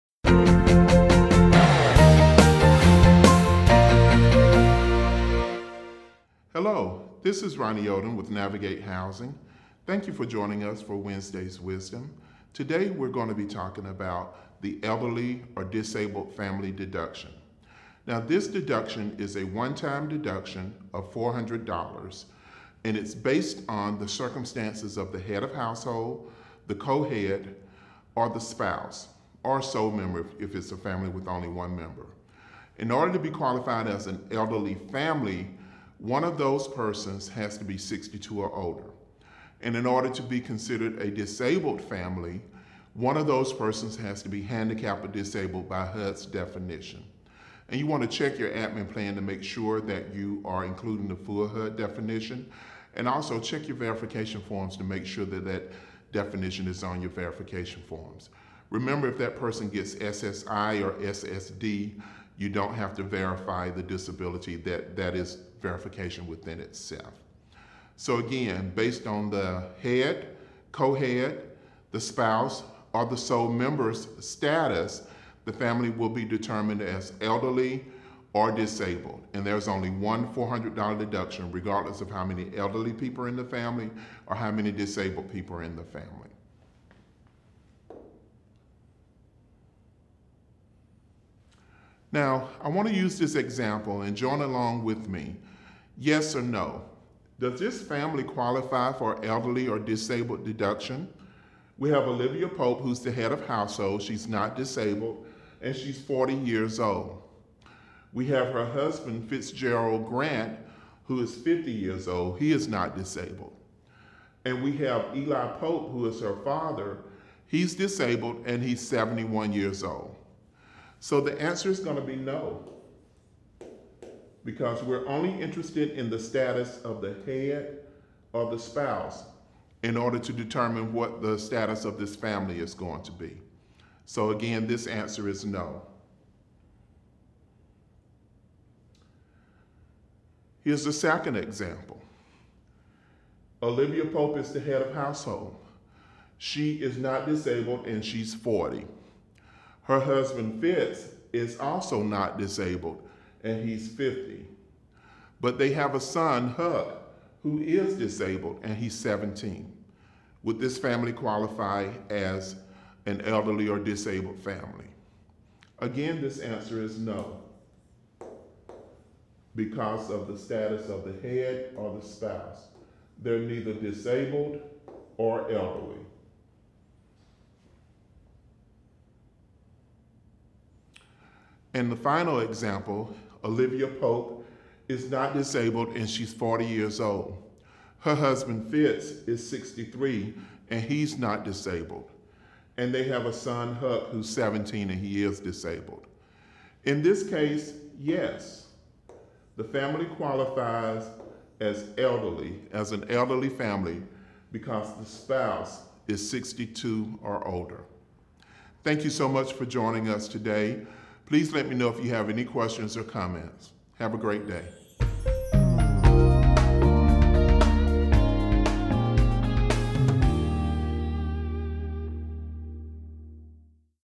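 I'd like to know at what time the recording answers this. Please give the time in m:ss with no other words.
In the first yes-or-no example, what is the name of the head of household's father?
1:55.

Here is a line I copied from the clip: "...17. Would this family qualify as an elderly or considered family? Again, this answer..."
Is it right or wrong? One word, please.
wrong.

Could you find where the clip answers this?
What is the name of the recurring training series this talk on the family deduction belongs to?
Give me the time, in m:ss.
0:10.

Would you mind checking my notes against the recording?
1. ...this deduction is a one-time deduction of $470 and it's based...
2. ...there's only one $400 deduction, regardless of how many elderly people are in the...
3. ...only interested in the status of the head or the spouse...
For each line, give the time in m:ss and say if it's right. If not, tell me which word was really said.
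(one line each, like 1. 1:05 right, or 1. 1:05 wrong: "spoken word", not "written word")
1. 0:18 wrong: "400", not "470"
2. 1:19 right
3. 2:05 right.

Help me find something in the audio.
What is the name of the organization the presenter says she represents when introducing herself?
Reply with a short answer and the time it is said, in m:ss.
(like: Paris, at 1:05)
Navigate Housing, at 0:08.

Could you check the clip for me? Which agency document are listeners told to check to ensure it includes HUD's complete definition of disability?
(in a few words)
admin plan.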